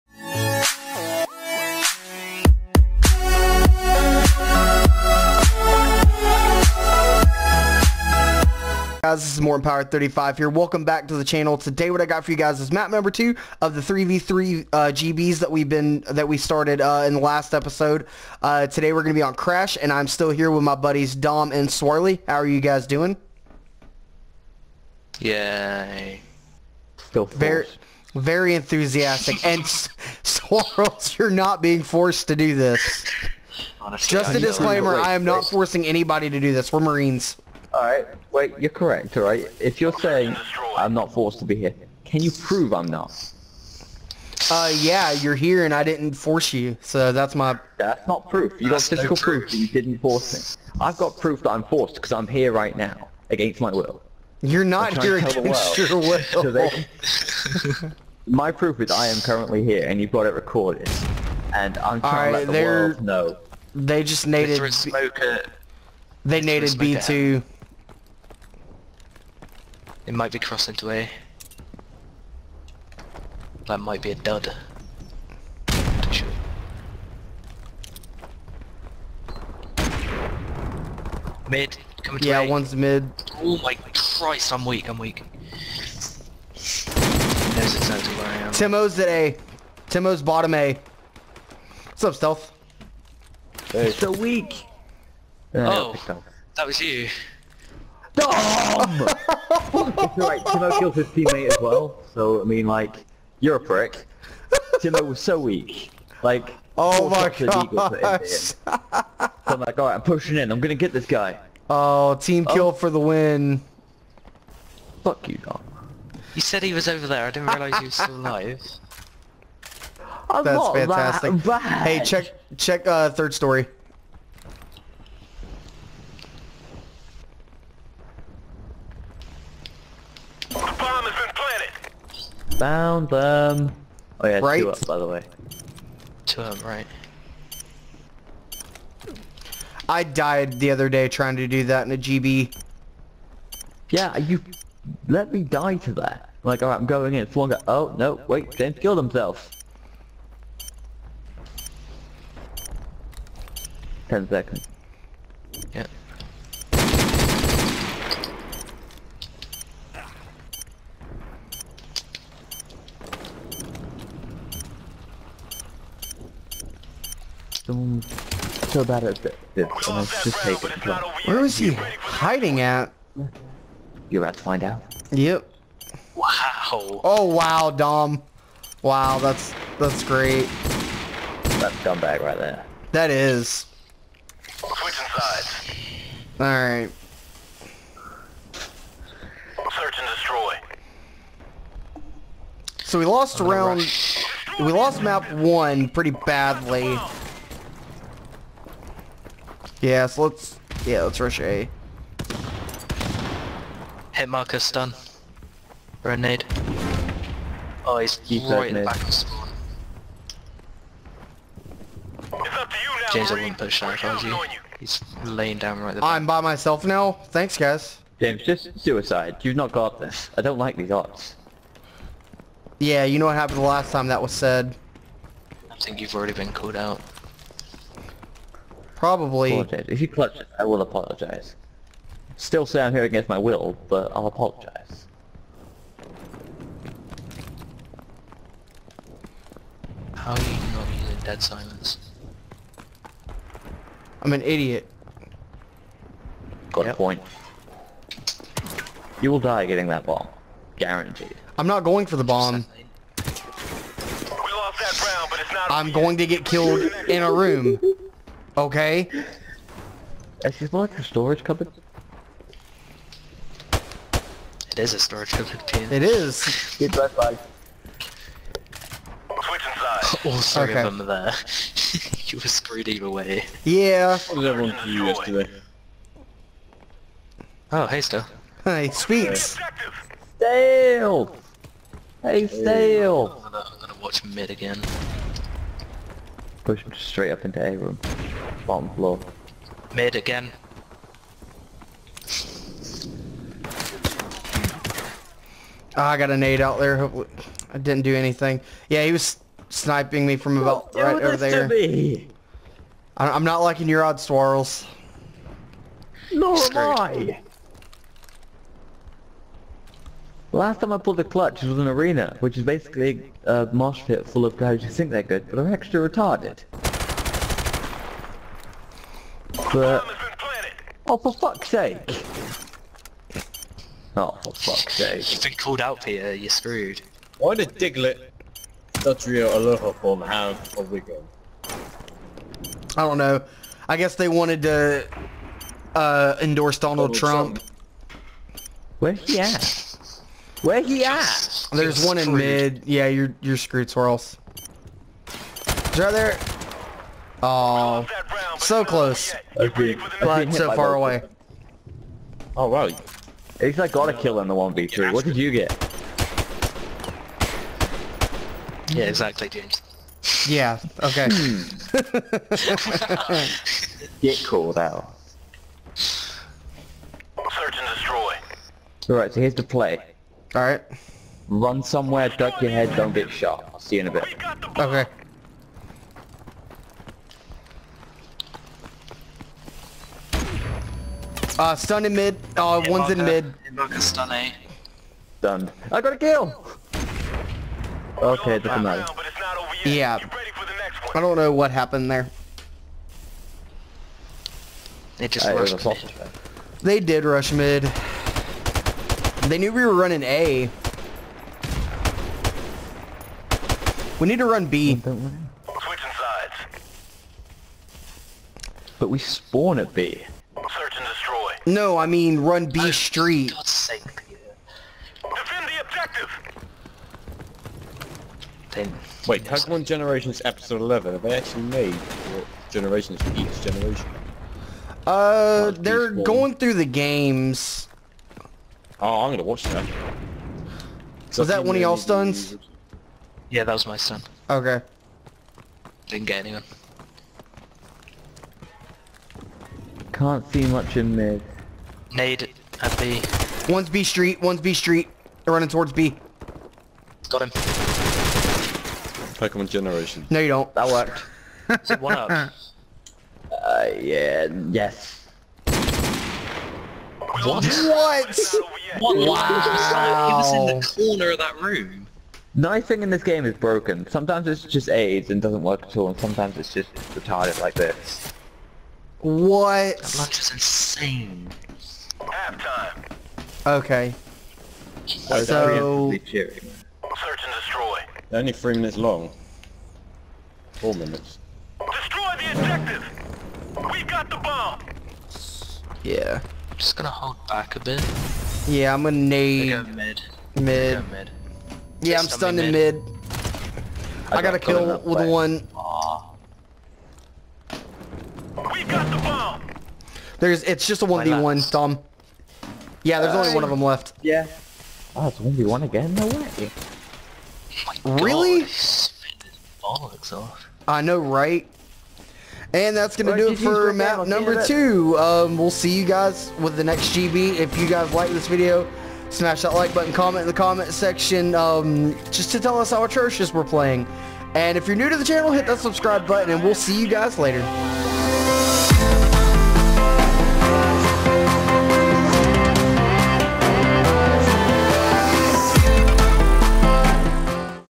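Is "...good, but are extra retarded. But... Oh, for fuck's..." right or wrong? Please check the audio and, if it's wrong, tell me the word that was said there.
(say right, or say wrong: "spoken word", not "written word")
right.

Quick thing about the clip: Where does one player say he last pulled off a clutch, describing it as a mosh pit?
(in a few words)
Arena.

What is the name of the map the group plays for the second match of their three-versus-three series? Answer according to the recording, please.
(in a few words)
Crash.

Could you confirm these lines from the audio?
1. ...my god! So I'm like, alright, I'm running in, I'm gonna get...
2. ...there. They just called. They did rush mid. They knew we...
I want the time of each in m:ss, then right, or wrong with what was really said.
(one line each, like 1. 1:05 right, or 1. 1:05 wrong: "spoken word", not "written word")
1. 1:47 wrong: "pushing", not "running"
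2. 6:32 wrong: "rushed", not "called".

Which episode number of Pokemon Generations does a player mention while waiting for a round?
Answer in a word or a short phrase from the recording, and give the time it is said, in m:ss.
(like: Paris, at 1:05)
11, at 7:00.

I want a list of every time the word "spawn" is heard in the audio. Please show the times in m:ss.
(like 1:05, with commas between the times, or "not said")
3:29, 6:49.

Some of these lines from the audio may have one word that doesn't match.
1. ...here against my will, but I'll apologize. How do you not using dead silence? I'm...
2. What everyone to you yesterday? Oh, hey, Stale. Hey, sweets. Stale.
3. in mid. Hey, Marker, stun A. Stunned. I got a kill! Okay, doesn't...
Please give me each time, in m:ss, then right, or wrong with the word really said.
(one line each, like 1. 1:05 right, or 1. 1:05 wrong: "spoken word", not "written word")
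1. 3:52 right
2. 4:34 right
3. 6:23 right.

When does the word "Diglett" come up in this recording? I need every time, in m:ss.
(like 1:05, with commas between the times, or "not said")
5:27.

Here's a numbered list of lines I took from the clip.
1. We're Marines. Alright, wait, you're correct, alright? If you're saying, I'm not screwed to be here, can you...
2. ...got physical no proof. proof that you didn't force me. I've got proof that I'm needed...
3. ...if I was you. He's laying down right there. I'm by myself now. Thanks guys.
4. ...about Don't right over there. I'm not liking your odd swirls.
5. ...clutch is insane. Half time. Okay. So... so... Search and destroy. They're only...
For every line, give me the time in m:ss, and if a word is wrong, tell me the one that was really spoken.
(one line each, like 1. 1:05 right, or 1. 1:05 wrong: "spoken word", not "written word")
1. 0:36 wrong: "forced", not "screwed"
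2. 0:48 wrong: "forced", not "needed"
3. 3:33 right
4. 5:00 right
5. 7:50 wrong: "lunch", not "clutch".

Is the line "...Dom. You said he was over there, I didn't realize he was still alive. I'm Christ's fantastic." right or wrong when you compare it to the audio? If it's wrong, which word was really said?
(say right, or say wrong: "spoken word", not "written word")
wrong: "That", not "Christ".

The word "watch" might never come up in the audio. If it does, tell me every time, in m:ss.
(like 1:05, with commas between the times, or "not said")
4:44, 7:09.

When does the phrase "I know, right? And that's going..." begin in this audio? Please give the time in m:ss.
8:30.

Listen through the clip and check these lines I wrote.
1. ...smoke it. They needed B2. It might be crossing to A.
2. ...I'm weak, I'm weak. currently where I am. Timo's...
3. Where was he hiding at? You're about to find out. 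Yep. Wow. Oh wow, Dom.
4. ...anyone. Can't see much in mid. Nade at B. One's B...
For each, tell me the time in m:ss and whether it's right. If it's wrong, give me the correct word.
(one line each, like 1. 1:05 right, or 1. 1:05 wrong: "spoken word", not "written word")
1. 1:04 right
2. 1:24 wrong: "exactly", not "currently"
3. 2:51 right
4. 7:16 right.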